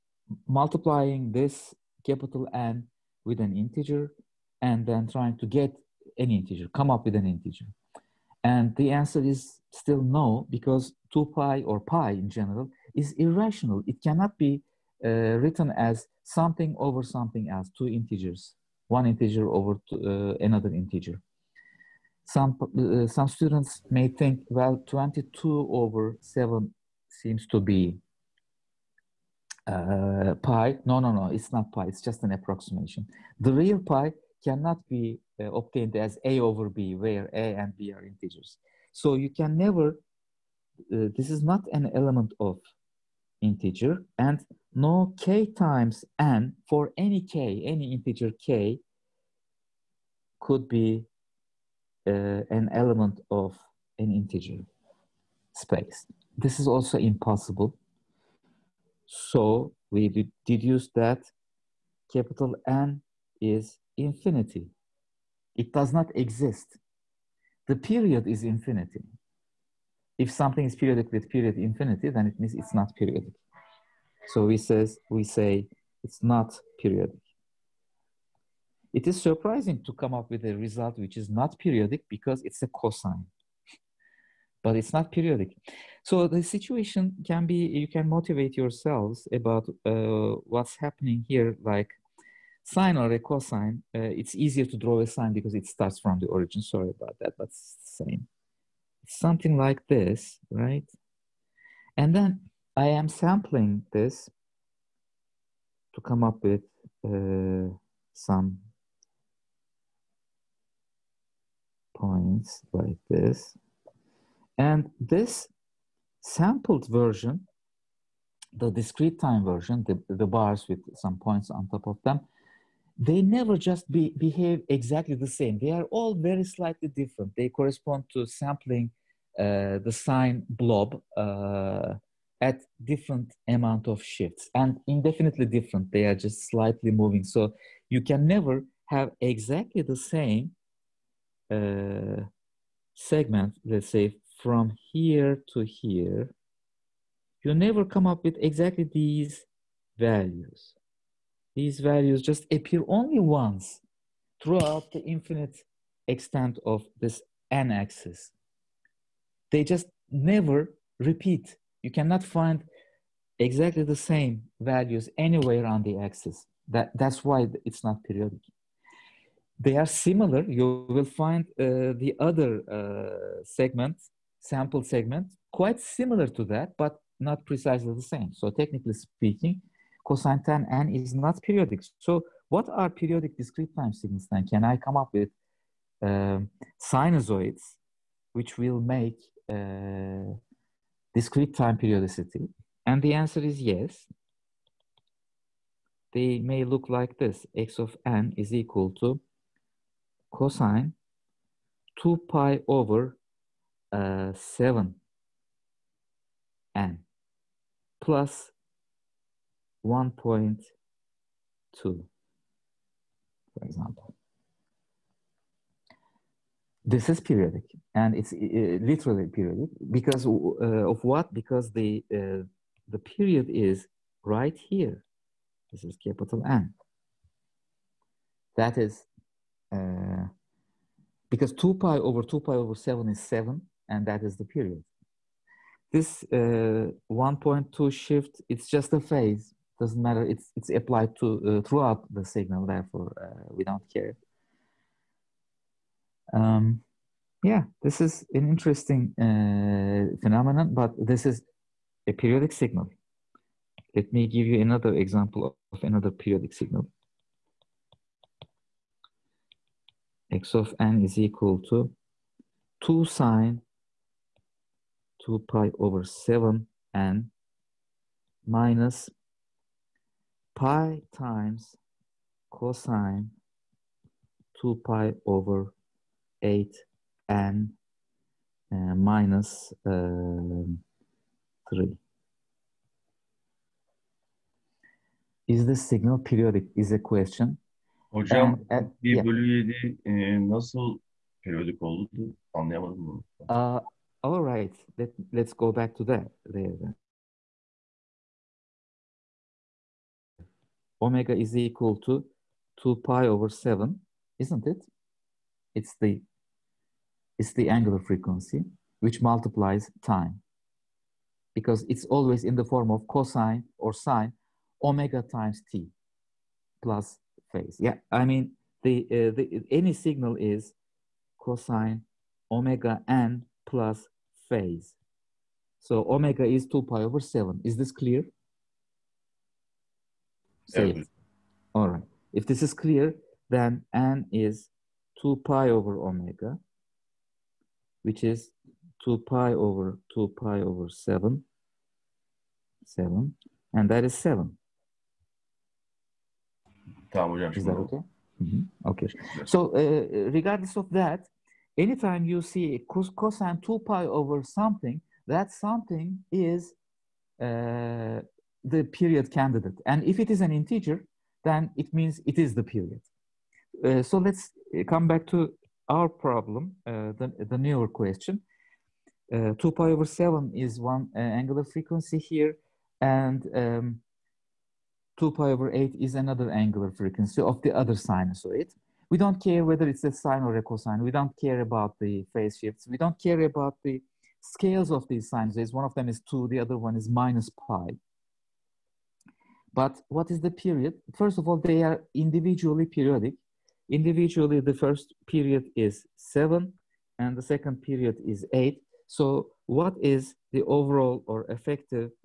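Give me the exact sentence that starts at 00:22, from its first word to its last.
Some, uh, some students may think, well, 22 over 7 seems to be uh, pi.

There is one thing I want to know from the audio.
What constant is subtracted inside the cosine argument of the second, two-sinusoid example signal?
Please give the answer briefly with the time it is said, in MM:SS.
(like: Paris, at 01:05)
3, at 04:41.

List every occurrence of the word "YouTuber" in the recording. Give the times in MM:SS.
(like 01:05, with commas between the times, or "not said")
not said.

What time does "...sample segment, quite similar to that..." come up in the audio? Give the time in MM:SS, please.
02:54.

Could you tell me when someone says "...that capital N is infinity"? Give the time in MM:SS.
01:00.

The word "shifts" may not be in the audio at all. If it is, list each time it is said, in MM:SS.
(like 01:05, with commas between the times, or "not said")
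02:14, 03:57, 06:22.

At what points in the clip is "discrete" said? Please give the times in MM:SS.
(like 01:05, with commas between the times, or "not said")
01:58, 03:03, 03:11.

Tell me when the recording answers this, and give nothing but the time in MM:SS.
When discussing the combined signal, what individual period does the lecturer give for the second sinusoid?
06:38.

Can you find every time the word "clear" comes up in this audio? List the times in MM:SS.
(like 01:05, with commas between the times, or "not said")
05:27, 05:32.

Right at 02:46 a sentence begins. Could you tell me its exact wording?
That, that's why it's not periodic.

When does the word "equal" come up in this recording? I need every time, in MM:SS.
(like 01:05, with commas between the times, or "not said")
03:18, 04:21, 05:01.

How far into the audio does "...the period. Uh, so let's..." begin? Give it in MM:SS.
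06:02.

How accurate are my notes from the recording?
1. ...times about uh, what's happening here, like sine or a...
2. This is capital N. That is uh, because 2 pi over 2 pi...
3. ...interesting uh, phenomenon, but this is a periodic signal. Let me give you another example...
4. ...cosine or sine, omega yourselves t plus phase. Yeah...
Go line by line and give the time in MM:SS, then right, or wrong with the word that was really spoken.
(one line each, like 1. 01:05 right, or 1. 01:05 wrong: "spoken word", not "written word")
1. 01:28 wrong: "yourselves", not "times"
2. 03:45 right
3. 04:08 right
4. 05:13 wrong: "times", not "yourselves".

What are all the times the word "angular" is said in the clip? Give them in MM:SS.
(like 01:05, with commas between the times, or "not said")
05:07, 06:11, 06:16.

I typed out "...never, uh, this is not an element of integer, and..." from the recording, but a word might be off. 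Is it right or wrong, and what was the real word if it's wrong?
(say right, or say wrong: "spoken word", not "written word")
right.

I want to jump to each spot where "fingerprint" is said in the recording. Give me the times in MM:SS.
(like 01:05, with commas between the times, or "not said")
not said.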